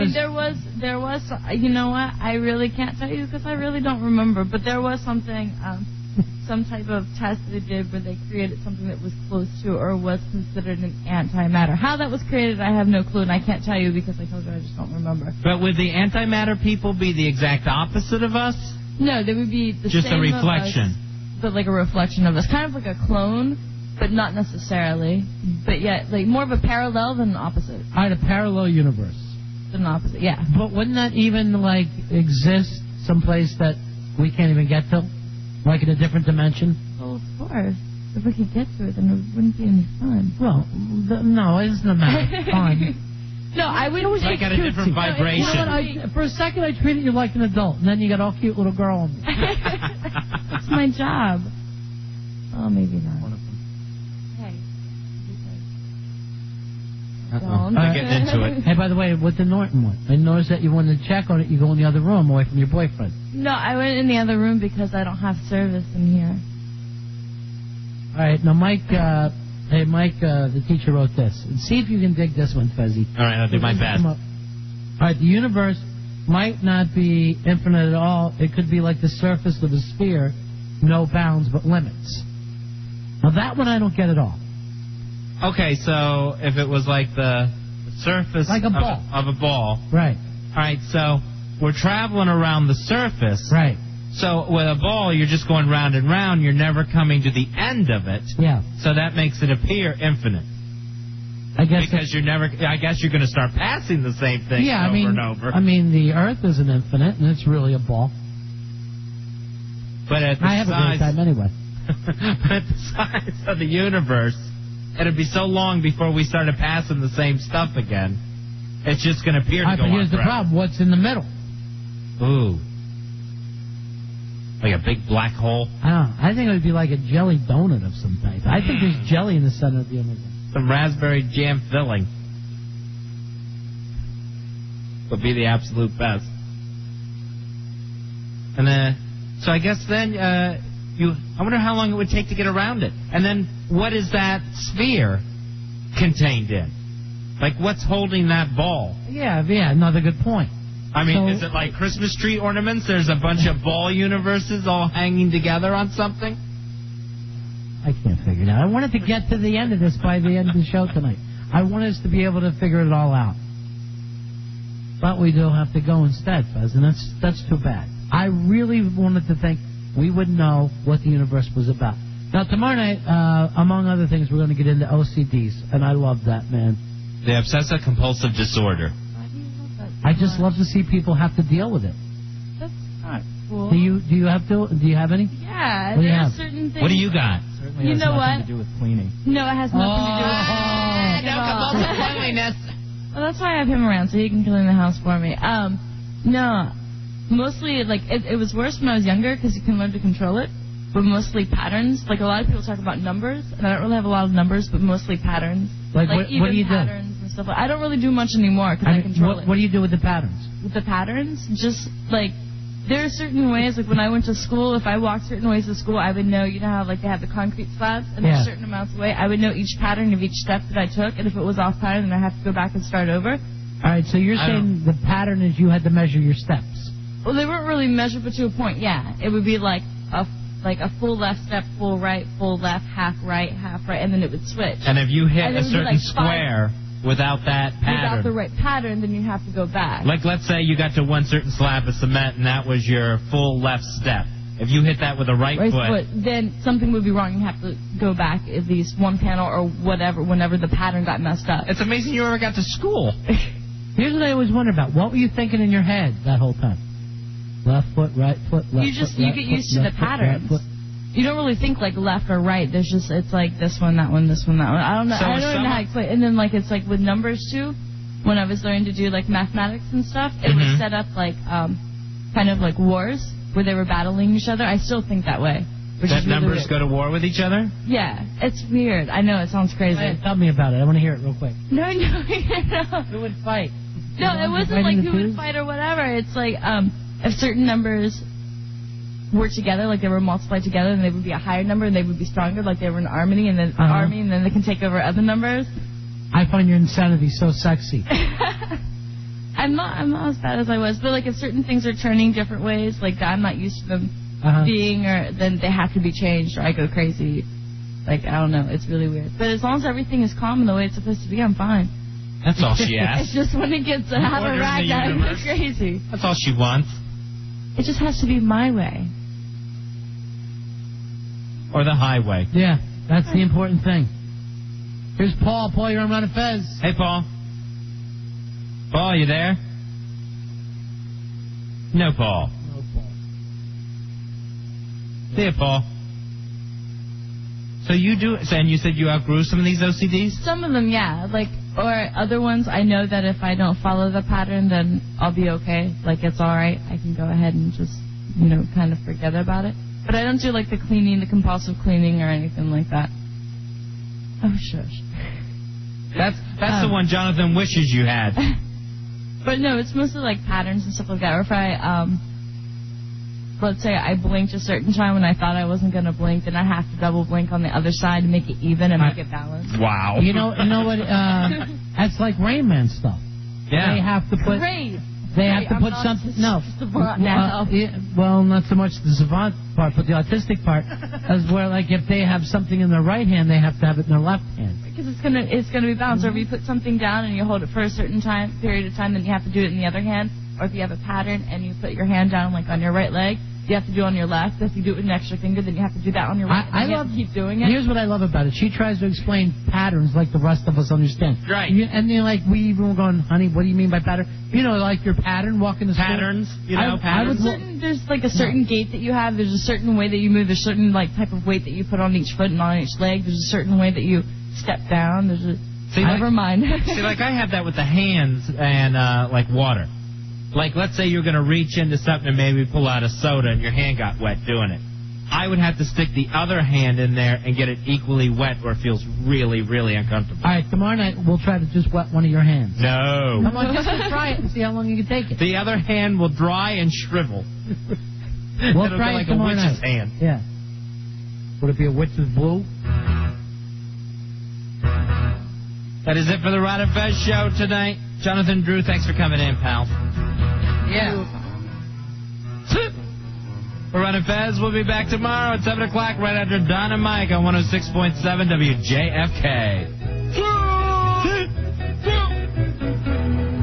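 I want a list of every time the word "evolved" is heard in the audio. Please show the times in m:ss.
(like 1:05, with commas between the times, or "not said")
not said.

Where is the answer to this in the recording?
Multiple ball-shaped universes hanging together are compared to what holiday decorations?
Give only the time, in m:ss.
2:31.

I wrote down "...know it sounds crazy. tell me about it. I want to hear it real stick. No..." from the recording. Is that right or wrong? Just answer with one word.
wrong.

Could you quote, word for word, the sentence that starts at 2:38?
I wanted to get to the end of this by the end of the show tonight.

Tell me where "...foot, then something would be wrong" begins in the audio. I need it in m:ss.
4:06.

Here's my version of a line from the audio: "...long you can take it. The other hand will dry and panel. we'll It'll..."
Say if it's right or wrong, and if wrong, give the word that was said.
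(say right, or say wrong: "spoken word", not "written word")
wrong: "shrivel", not "panel".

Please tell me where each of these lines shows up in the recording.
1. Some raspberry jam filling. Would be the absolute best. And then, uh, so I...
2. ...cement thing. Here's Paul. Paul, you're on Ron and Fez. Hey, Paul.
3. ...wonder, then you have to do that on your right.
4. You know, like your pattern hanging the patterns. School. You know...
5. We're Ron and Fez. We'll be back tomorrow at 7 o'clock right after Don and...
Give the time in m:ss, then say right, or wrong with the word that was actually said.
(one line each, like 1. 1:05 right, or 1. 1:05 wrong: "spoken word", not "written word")
1. 2:10 right
2. 5:23 wrong: "important", not "cement"
3. 6:35 wrong: "finger", not "wonder"
4. 6:44 wrong: "walking", not "hanging"
5. 7:33 right.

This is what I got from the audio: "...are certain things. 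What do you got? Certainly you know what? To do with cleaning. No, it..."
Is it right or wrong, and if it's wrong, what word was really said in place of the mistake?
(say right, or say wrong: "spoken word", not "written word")
right.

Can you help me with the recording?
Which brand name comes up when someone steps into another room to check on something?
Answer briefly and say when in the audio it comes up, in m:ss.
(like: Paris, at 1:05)
Norton, at 0:59.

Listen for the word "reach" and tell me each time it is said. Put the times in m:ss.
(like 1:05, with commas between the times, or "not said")
7:01.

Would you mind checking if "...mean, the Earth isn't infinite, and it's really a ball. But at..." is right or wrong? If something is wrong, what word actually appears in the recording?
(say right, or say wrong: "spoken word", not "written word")
right.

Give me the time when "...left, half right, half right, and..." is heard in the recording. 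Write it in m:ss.
3:52.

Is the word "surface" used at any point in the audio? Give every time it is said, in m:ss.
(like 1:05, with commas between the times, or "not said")
1:19, 1:27, 1:32.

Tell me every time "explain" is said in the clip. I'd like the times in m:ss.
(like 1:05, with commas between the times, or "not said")
4:25, 6:39.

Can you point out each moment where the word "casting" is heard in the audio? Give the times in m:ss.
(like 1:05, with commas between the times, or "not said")
not said.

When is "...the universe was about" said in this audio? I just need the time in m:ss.
2:51.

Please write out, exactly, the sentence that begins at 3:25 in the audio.
Like, like what, even what do you patterns do?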